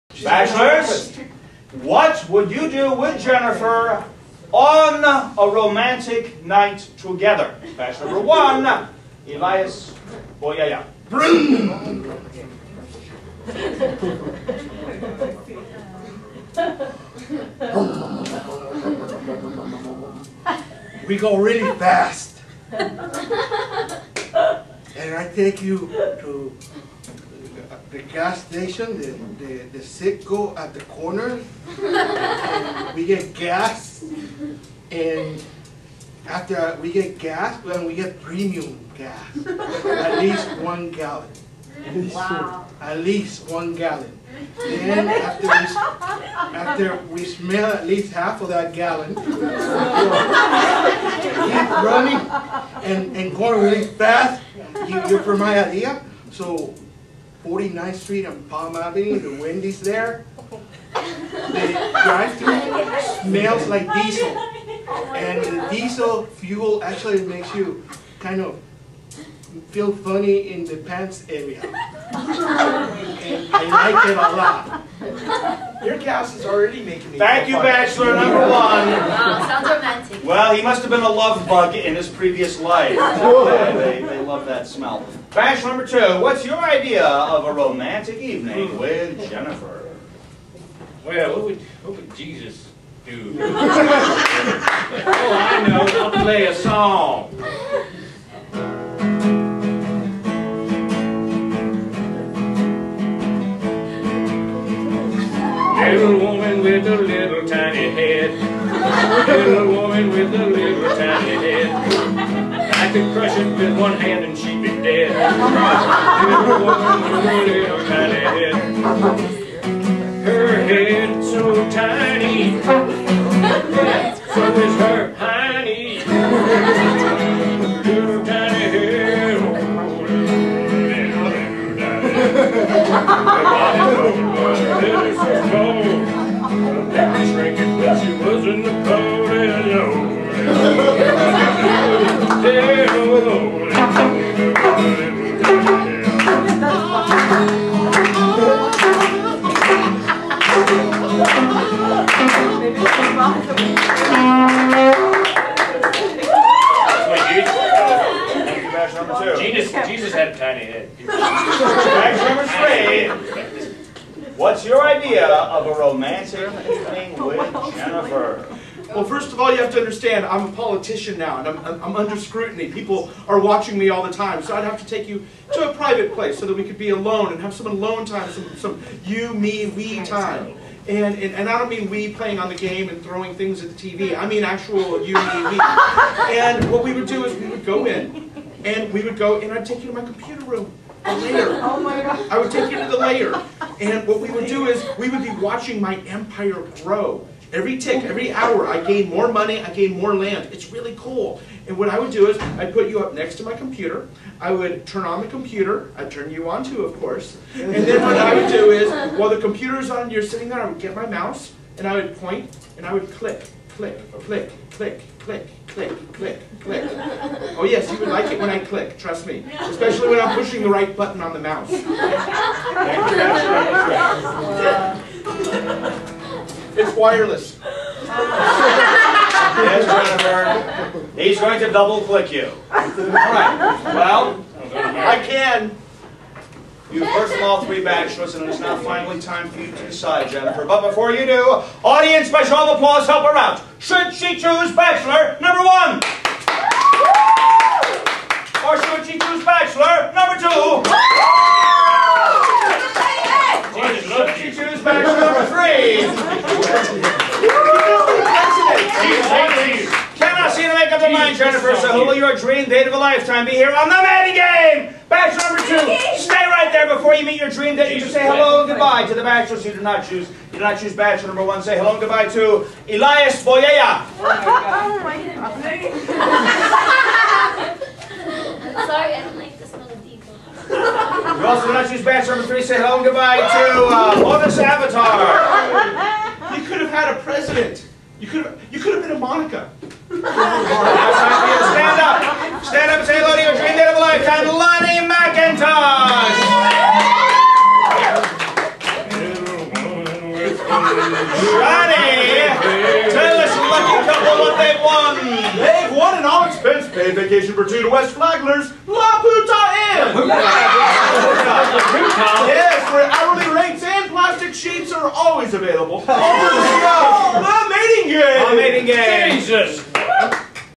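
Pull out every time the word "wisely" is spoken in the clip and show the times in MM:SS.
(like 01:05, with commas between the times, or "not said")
not said.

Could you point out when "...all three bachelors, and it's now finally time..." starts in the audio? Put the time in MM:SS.
03:57.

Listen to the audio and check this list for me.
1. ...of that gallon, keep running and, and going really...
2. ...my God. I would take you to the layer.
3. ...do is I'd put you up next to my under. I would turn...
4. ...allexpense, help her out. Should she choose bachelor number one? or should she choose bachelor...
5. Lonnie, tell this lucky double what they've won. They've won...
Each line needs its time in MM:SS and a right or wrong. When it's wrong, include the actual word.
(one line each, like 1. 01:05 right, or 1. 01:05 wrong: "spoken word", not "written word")
1. 00:48 right
2. 03:11 right
3. 03:22 wrong: "computer", not "under"
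4. 04:02 wrong: "applause", not "allexpense"
5. 05:01 wrong: "couple", not "double".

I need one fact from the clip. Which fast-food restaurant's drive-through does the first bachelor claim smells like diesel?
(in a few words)
Wendy's.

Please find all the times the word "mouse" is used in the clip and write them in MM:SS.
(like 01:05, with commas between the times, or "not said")
03:31, 03:41.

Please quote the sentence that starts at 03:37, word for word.
Oh yes, you would like it when I click, trust me.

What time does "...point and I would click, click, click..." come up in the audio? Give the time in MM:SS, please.
03:32.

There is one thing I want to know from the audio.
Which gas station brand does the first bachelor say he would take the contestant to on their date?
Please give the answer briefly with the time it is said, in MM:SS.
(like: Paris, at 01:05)
Citgo, at 00:29.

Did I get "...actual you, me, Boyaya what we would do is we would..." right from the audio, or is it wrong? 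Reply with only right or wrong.
wrong.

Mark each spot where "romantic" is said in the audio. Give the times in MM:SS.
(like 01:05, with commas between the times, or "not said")
00:05, 01:19, 01:27, 02:45.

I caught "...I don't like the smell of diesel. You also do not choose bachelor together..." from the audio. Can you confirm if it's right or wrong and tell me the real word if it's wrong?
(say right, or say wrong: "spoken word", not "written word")
wrong: "number", not "together".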